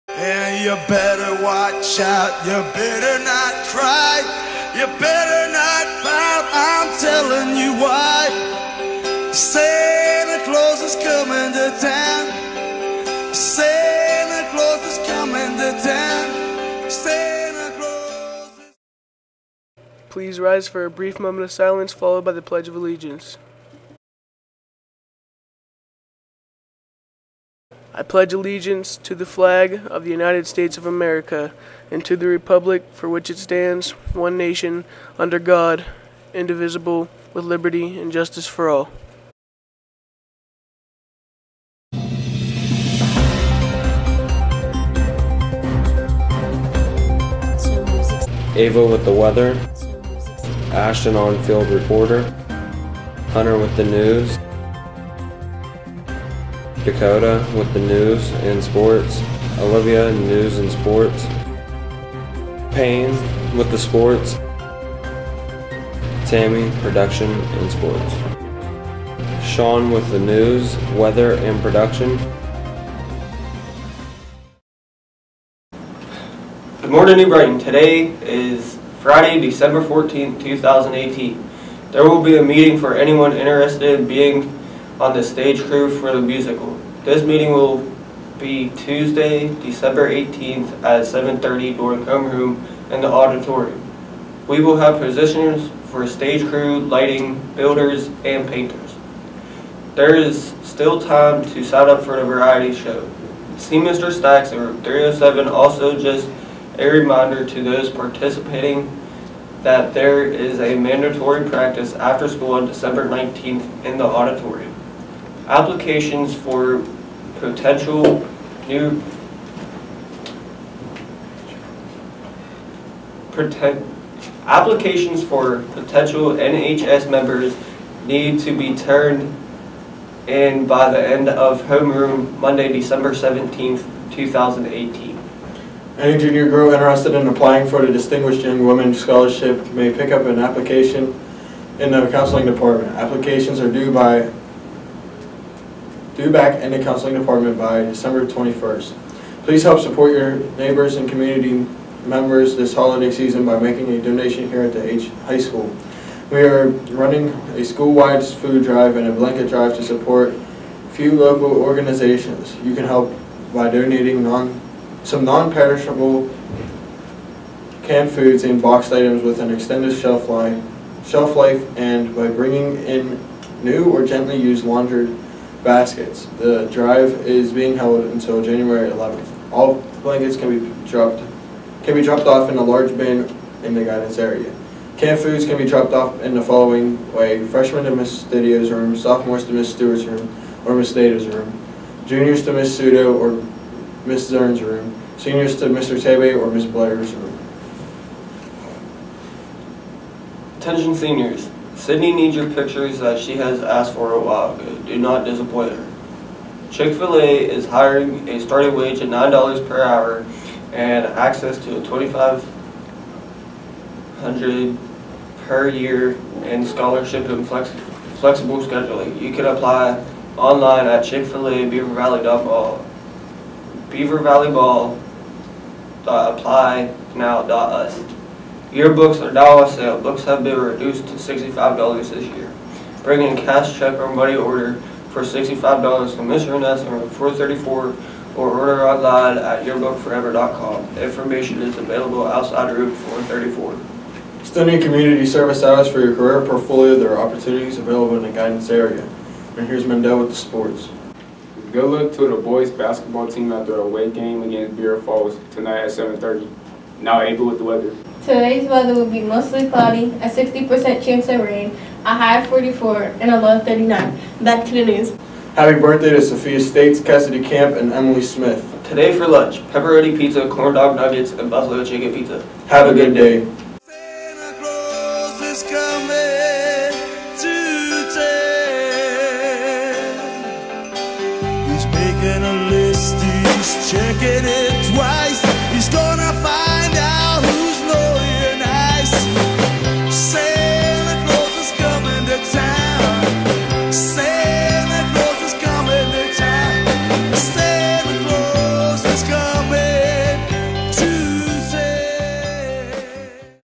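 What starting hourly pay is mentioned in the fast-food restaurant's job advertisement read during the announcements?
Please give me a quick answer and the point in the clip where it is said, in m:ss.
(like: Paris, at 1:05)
$9, at 3:29.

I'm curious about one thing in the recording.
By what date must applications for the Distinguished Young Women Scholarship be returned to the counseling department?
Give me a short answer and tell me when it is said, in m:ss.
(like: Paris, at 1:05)
December 21st, at 2:27.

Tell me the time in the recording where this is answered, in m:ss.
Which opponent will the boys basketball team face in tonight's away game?
4:14.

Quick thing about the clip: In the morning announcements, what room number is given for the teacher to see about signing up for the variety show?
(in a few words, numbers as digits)
307.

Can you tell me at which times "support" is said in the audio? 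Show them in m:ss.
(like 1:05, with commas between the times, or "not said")
2:29, 2:39.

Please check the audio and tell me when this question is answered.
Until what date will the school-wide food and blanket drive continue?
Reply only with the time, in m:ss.
2:58.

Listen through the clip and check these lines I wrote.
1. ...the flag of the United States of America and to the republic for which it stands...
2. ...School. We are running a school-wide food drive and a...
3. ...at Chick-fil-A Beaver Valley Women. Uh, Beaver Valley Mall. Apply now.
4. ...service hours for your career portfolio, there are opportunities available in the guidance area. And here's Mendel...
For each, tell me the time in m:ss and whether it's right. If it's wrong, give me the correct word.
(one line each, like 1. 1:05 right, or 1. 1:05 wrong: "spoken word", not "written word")
1. 0:29 right
2. 2:35 right
3. 3:40 wrong: "Mall", not "Women"
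4. 4:05 right.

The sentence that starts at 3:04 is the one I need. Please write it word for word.
Canned foods can be dropped off in the following way.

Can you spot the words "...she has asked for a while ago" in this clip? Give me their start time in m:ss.
3:23.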